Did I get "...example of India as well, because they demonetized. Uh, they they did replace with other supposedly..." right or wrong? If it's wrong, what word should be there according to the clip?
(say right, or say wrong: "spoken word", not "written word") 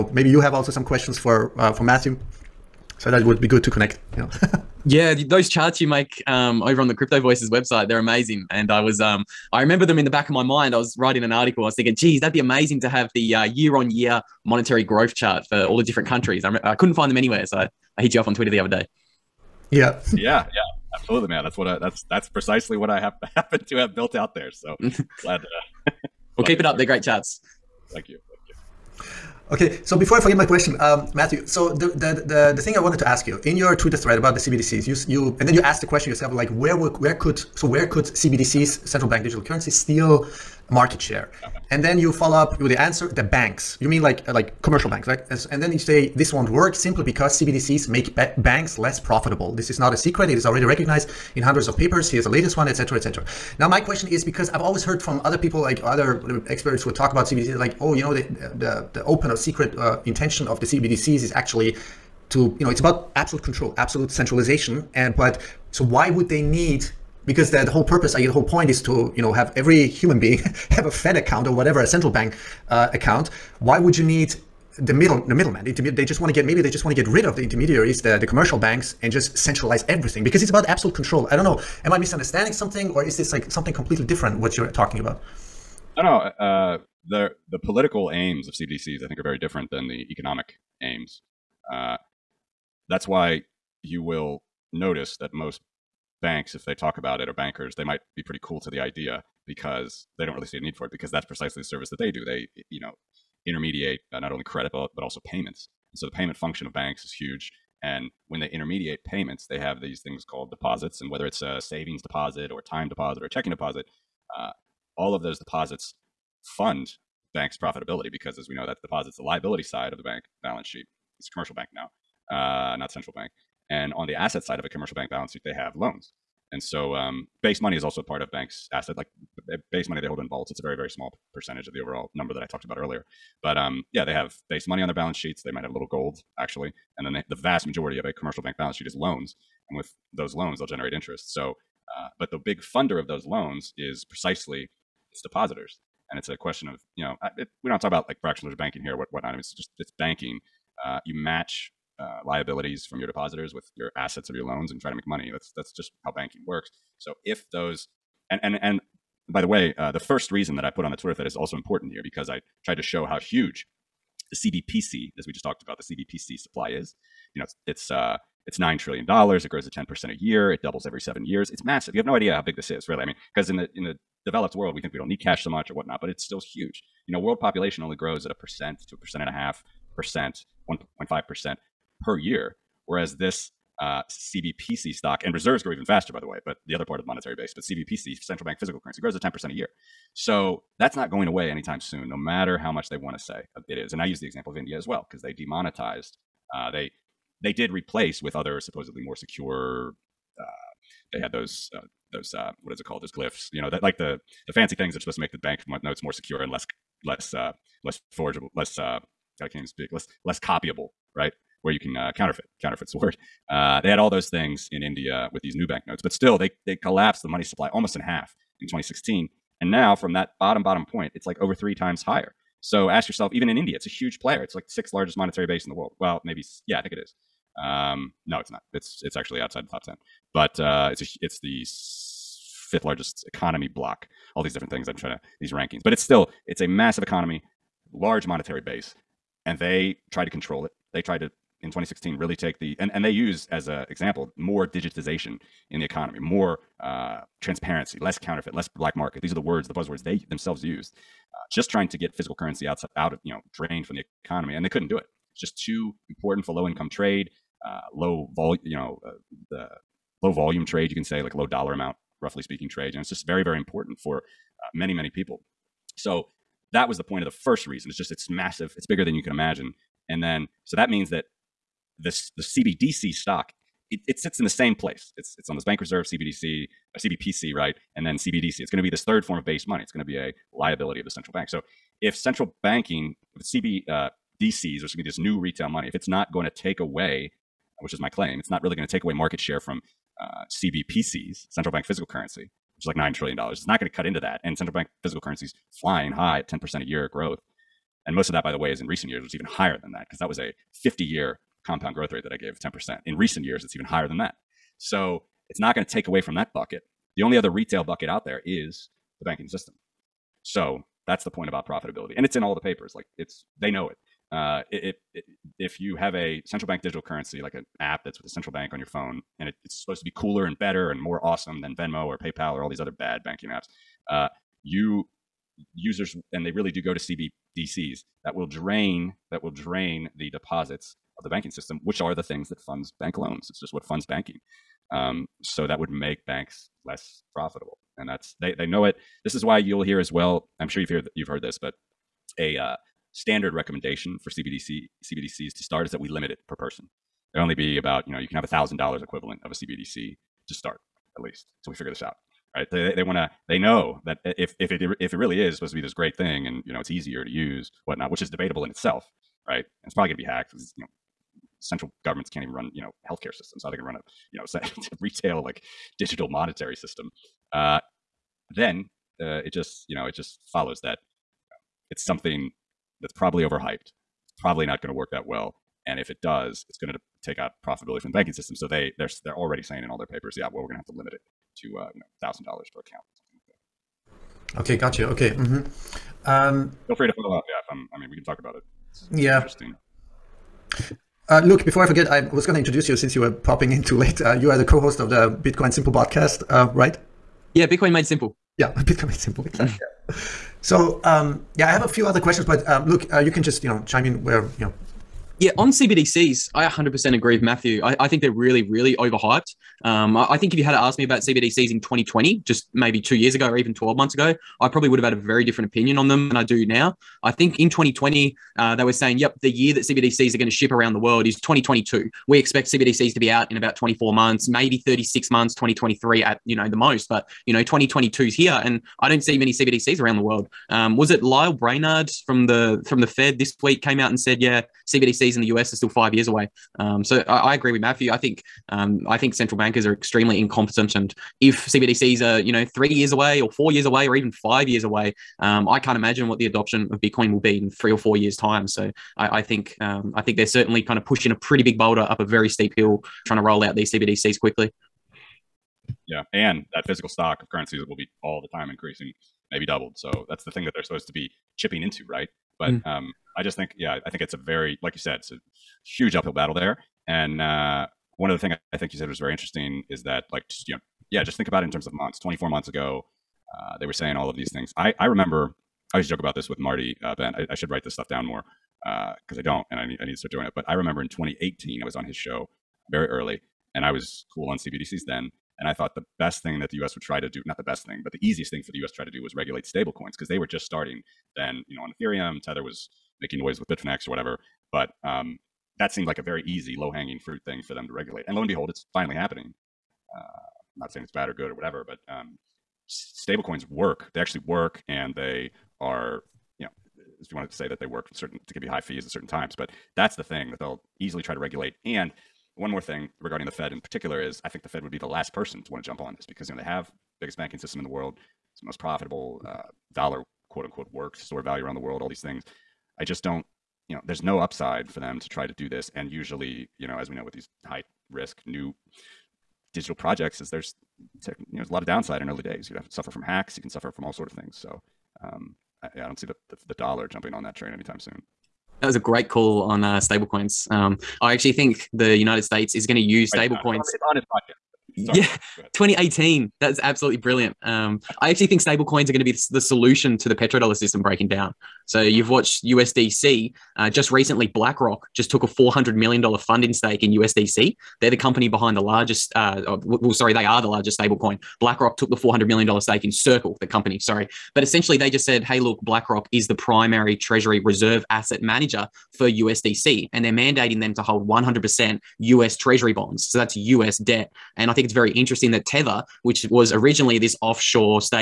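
right.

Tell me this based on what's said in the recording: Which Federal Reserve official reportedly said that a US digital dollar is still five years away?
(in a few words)
Lael Brainard.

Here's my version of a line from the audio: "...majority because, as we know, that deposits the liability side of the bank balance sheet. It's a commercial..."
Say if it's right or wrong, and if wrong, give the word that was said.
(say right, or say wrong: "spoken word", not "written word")
wrong: "profitability", not "majority".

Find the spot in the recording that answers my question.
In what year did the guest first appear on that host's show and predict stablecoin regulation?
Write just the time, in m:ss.
8:00.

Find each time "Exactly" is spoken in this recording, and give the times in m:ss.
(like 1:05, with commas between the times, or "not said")
6:39.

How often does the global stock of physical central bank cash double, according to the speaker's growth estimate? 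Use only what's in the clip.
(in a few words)
every 7 years.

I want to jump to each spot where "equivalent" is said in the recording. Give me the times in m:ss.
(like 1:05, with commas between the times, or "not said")
5:49.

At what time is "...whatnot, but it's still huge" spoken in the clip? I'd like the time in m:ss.
2:55.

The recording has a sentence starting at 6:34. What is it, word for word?
Uh, you are the co-host of the Bitcoin Simple podcast, uh, right?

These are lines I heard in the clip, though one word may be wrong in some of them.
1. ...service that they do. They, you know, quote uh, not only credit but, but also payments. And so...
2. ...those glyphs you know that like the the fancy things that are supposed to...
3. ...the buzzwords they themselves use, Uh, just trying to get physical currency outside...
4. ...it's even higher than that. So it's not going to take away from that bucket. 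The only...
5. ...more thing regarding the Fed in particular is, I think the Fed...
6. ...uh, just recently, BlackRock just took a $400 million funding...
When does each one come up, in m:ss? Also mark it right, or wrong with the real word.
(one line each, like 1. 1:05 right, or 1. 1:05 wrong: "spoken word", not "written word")
1. 1:41 wrong: "intermediate", not "quote"
2. 3:23 right
3. 4:09 right
4. 5:03 right
5. 8:32 right
6. 9:13 right.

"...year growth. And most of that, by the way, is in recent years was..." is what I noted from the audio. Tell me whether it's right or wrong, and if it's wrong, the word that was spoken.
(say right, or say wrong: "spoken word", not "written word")
right.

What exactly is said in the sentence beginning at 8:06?
would try to do—not the best thing, but the easiest thing for the U.S.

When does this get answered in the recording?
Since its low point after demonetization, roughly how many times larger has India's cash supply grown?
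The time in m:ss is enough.
3:41.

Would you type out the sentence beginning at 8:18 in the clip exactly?
And lo and behold, it's finally happening.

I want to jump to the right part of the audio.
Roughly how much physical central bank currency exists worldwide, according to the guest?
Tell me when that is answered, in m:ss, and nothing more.
2:48.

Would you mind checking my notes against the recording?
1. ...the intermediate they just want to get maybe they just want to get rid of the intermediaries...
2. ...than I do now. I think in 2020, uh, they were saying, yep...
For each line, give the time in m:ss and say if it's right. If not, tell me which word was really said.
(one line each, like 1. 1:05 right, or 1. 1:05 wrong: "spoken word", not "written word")
1. 1:15 right
2. 6:56 right.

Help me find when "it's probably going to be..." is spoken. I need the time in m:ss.
5:59.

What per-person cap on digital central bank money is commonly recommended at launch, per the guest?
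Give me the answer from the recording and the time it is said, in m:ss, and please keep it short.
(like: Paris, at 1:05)
$1,000, at 5:48.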